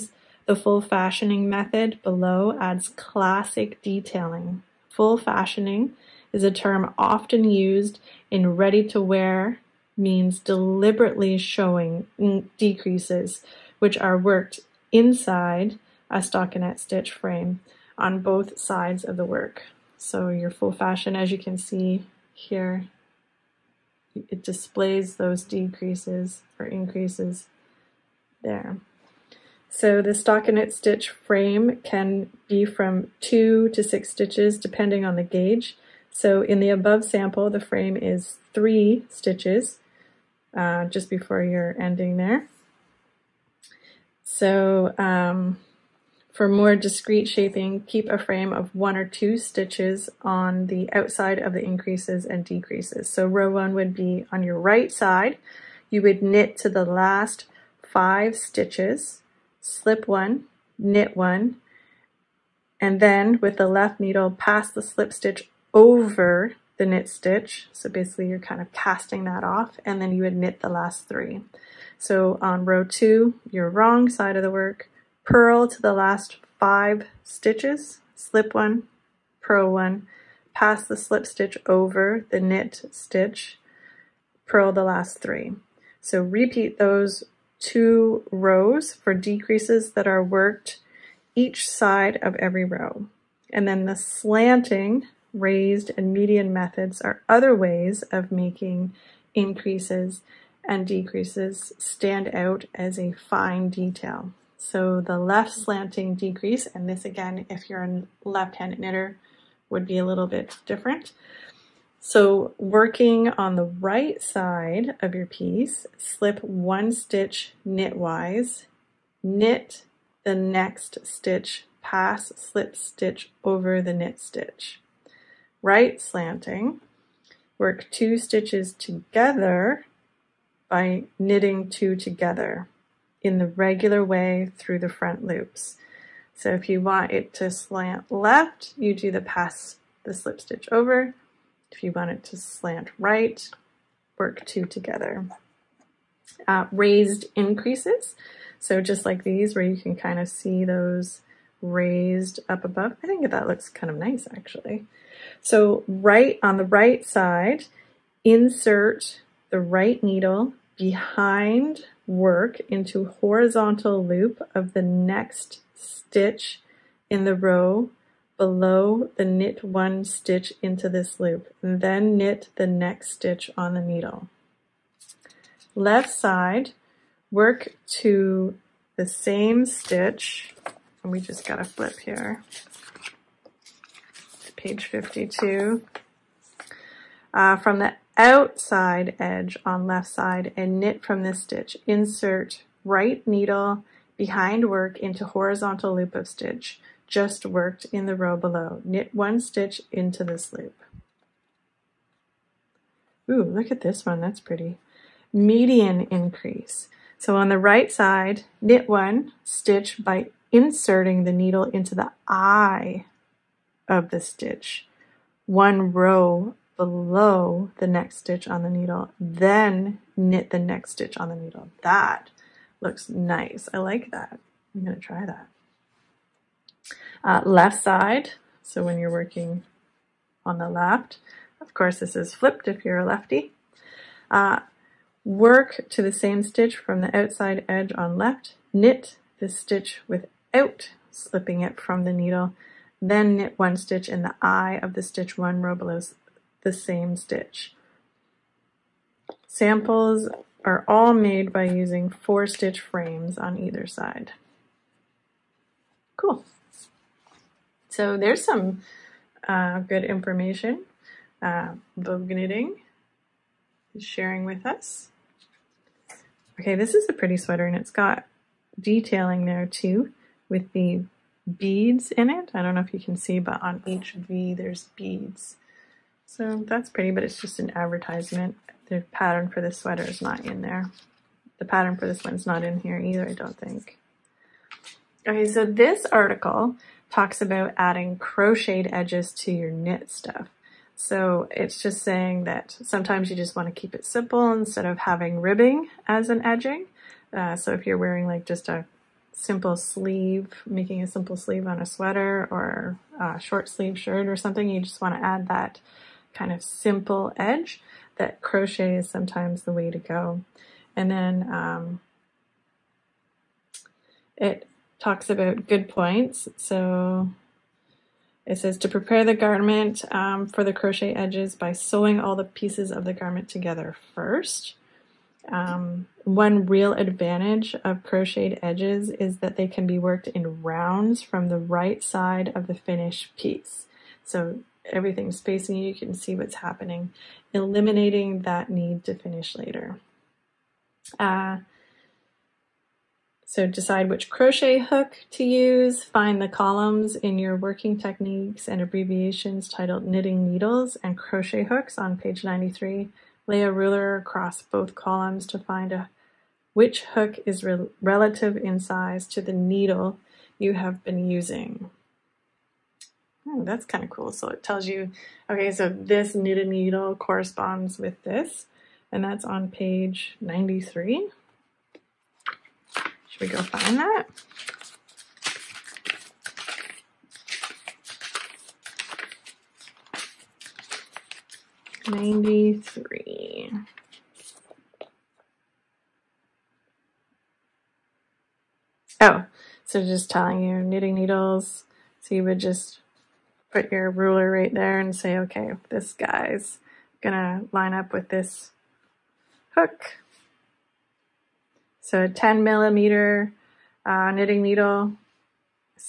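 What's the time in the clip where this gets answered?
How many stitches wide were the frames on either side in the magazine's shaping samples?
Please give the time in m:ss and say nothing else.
4:12.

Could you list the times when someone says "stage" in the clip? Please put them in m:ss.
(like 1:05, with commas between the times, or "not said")
not said.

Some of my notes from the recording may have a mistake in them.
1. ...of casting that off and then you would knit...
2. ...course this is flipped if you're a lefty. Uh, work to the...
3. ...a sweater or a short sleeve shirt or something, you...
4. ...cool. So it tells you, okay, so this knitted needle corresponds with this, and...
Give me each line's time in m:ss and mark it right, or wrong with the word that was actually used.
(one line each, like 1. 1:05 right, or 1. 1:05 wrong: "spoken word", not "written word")
1. 1:08 right
2. 3:51 right
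3. 5:01 right
4. 6:04 right.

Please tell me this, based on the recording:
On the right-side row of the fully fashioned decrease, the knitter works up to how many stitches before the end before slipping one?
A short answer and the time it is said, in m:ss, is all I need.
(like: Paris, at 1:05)
5, at 0:56.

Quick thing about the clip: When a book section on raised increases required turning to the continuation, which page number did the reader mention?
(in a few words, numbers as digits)
52.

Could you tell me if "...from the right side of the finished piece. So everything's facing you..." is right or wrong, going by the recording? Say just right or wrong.
right.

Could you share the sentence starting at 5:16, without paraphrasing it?
So it says to prepare the garment um, for the crochet edges by sewing all the pieces of the garment together first.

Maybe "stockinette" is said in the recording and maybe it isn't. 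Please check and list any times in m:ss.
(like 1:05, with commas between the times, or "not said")
0:16, 0:30.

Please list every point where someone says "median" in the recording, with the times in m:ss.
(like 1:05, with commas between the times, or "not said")
1:36, 3:25.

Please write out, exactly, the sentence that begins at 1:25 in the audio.
So repeat those two rows for decreases that are worked each side of every row.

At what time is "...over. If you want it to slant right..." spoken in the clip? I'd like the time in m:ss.
2:20.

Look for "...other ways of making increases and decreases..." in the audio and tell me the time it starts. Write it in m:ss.
1:37.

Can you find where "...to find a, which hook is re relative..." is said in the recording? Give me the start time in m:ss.
5:55.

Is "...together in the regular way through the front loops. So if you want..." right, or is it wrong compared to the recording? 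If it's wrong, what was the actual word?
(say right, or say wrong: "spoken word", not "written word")
right.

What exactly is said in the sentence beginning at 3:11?
Insert right needle behind work into horizontal loop of stitch just worked in the row below.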